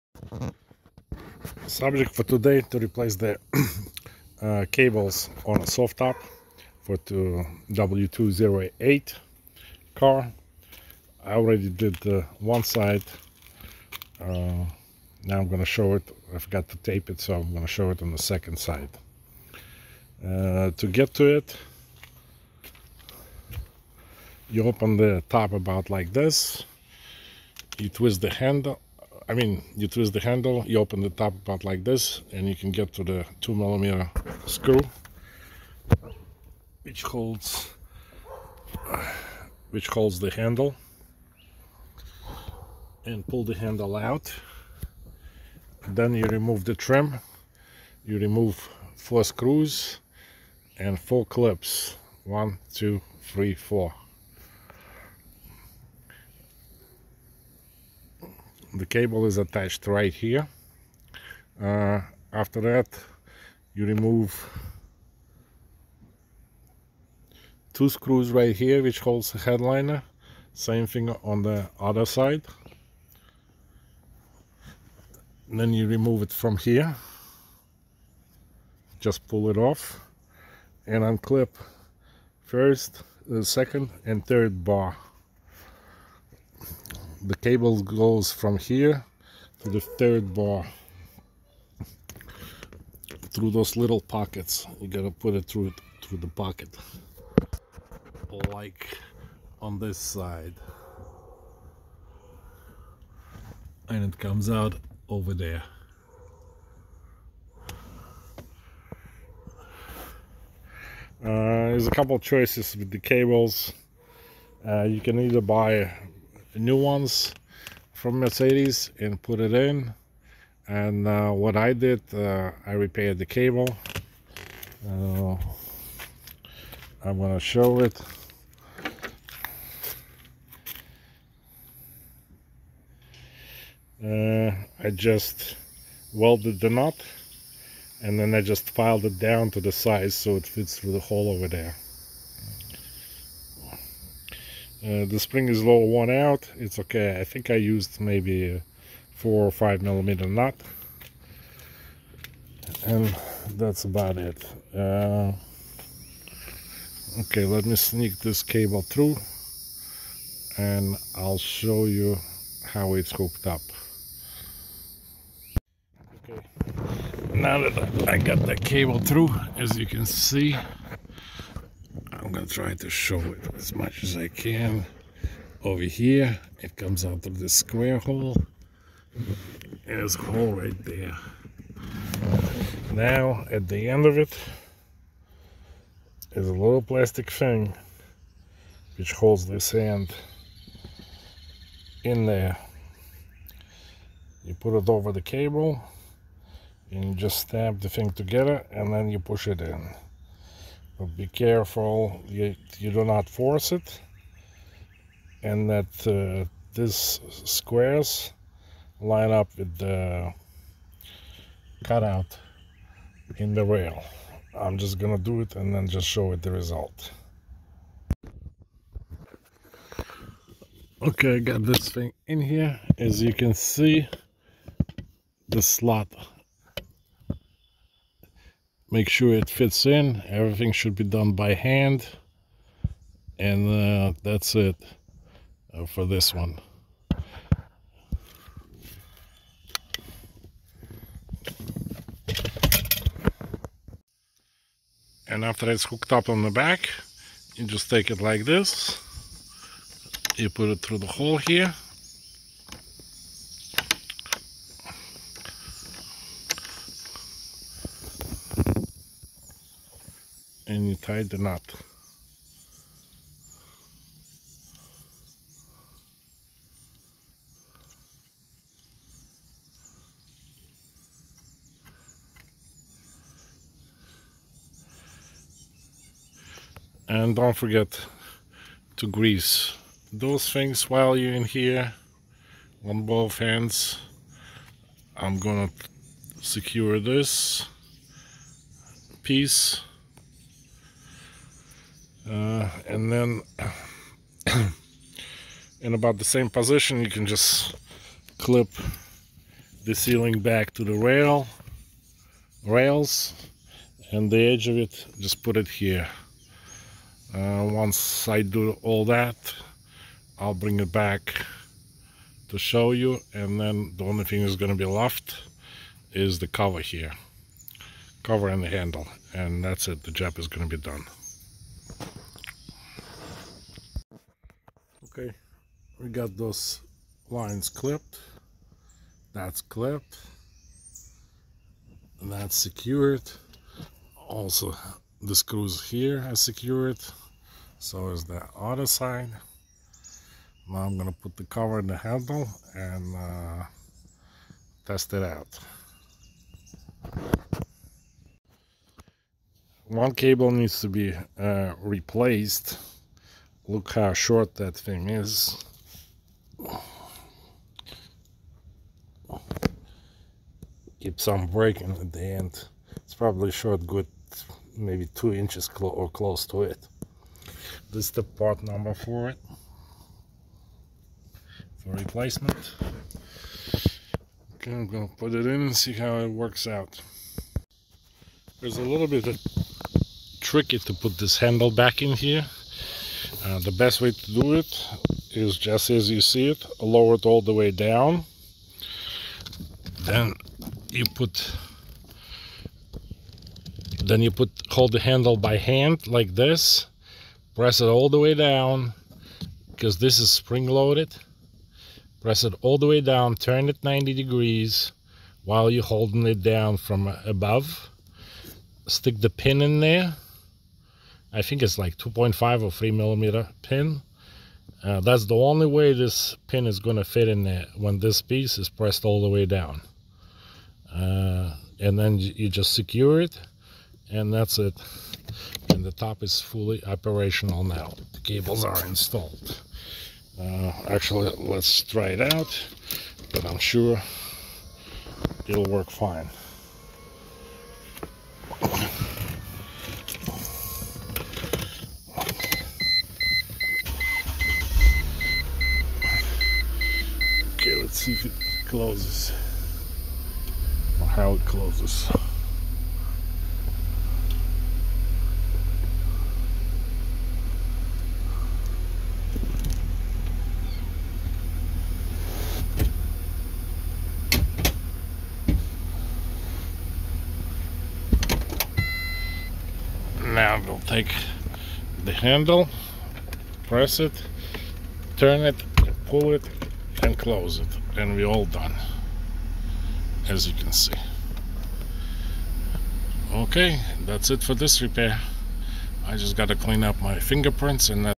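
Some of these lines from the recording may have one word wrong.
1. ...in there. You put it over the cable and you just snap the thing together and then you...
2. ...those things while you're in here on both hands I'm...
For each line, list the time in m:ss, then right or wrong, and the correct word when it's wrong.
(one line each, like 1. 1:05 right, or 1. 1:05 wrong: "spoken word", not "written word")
1. 3:12 right
2. 4:40 right.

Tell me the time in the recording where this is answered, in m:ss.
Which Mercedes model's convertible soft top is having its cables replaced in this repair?
0:07.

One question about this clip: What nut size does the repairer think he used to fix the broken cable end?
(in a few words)
4 or 5 millimeter.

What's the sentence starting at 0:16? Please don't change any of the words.
I forgot to tape it, so I'm going to show it on the second side.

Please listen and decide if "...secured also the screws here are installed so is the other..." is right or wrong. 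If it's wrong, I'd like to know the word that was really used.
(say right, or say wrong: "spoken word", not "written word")
wrong: "secured", not "installed".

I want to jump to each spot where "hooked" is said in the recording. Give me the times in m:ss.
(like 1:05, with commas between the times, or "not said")
2:43, 4:05.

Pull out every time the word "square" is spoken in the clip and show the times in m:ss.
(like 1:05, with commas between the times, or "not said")
2:57, 3:27.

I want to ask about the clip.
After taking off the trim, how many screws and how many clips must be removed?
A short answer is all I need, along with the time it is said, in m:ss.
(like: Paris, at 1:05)
4 screws and 4 clips, at 0:48.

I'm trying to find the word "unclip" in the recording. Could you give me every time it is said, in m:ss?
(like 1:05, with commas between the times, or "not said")
1:21.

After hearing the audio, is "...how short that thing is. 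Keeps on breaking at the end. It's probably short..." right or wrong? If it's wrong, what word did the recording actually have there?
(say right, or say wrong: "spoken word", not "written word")
right.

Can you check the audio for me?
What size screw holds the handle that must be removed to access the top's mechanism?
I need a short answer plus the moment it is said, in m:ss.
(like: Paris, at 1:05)
2 millimeter, at 0:33.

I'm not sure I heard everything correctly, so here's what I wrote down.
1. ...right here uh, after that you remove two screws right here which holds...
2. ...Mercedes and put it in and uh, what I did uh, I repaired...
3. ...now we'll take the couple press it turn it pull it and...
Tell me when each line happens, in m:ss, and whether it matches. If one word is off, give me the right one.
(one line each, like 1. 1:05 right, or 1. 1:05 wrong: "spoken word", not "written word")
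1. 0:59 right
2. 1:58 right
3. 7:50 wrong: "handle", not "couple".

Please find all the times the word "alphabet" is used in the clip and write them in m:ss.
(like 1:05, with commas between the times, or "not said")
not said.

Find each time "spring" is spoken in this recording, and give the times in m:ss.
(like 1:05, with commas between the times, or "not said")
2:25, 6:40.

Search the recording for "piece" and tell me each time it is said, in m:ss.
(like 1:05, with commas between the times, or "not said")
4:49, 6:58.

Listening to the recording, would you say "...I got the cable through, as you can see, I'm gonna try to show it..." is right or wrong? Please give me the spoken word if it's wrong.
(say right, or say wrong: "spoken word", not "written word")
right.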